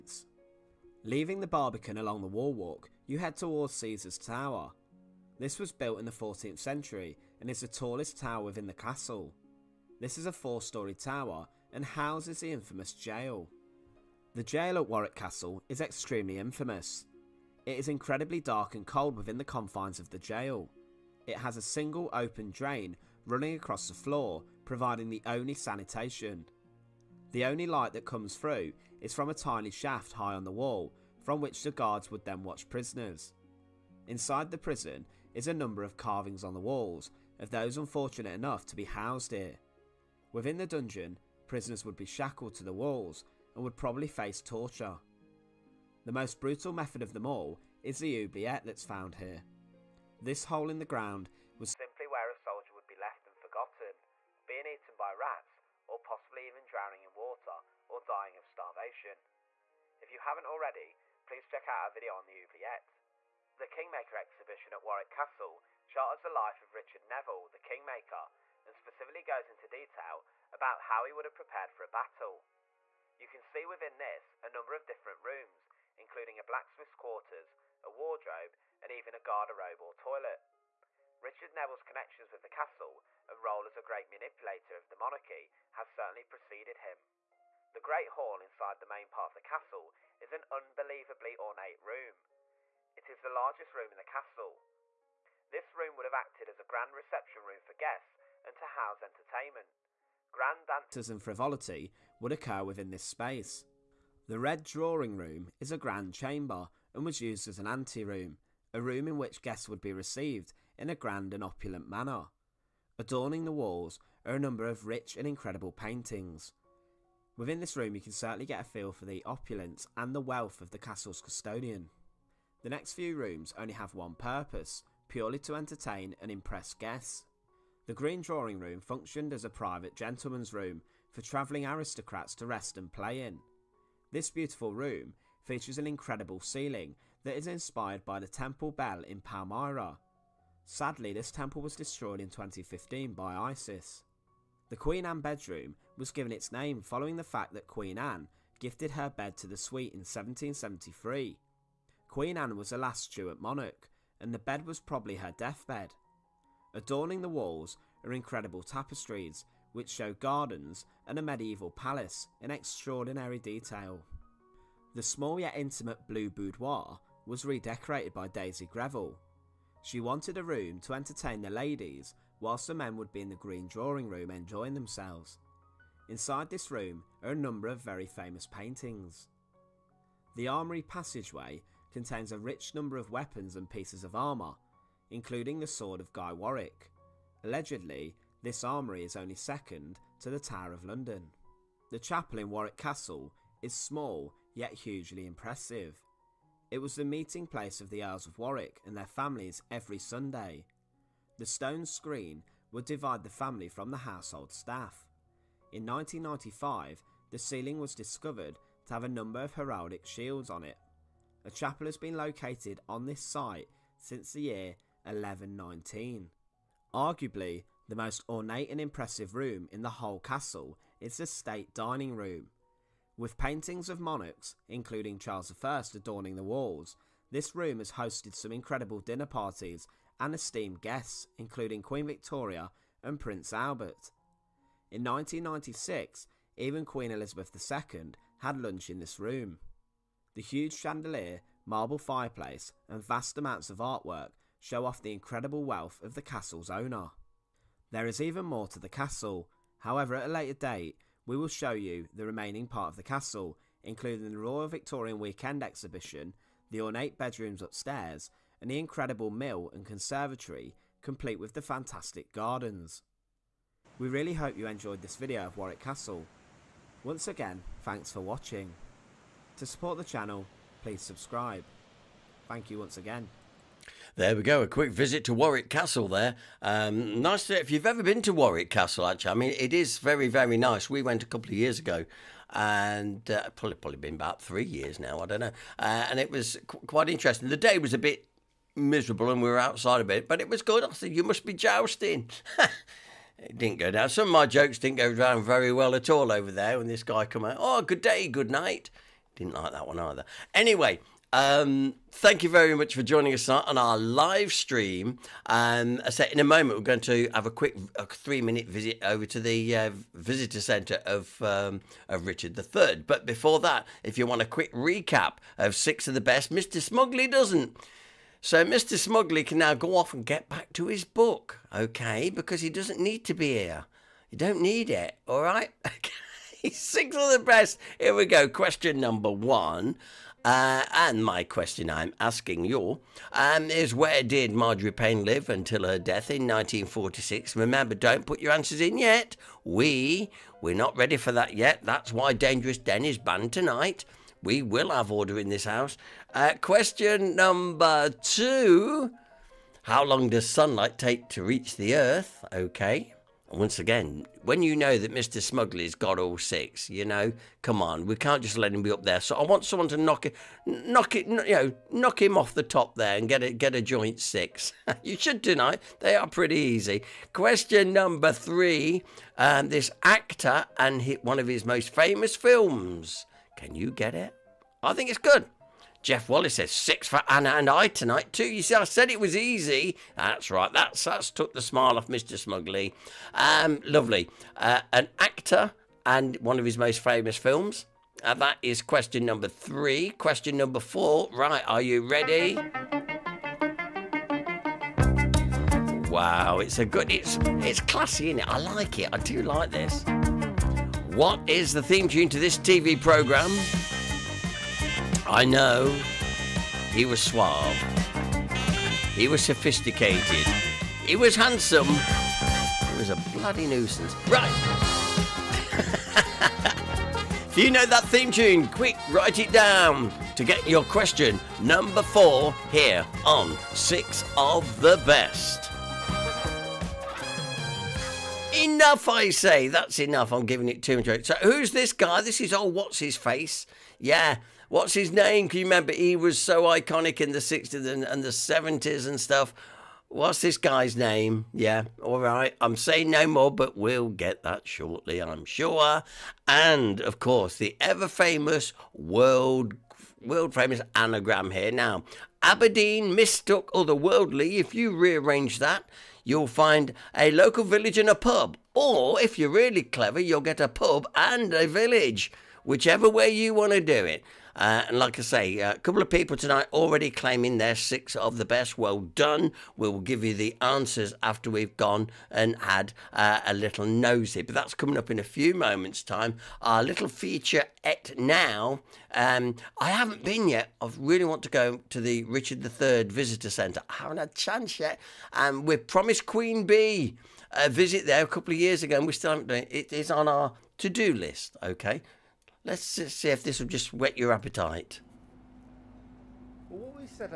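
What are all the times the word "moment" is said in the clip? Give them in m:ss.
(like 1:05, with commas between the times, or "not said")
5:06, 7:55.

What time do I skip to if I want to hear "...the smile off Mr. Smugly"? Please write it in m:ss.
6:21.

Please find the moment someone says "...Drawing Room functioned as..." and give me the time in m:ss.
2:08.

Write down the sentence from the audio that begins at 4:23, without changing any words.
We really hope you enjoyed this video of Warwick Castle.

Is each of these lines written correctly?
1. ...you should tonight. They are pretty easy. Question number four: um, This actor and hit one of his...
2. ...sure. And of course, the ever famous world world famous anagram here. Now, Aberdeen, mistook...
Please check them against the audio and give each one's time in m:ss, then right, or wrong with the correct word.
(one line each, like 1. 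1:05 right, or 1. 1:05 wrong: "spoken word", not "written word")
1. 6:05 wrong: "three", not "four"
2. 7:25 right.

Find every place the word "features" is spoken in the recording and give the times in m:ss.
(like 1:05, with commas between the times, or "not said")
2:15, 7:57.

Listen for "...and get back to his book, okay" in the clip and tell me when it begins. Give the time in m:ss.
5:20.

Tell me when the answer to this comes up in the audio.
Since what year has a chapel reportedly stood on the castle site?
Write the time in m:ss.
3:35.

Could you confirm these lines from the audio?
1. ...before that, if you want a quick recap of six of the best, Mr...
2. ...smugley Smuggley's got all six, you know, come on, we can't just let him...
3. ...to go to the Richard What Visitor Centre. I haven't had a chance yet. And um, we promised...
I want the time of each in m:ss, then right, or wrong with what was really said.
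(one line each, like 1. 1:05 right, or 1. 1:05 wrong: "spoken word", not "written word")
1. 5:13 right
2. 5:55 right
3. 8:01 wrong: "III", not "What".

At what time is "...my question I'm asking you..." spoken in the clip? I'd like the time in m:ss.
5:31.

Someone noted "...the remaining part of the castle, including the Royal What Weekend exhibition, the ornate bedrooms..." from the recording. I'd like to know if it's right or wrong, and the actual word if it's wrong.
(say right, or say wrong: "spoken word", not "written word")
wrong: "Victorian", not "What".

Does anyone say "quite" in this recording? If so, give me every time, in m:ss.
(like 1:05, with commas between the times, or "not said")
4:46.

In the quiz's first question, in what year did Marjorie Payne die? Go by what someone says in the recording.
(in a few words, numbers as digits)
1946.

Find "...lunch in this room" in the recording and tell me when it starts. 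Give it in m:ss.
3:58.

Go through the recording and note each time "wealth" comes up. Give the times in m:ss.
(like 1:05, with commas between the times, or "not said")
2:00, 4:05.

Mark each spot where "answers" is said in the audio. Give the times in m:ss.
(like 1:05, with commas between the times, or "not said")
5:38, 7:50.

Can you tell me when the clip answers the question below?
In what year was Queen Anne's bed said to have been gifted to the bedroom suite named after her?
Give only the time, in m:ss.
2:29.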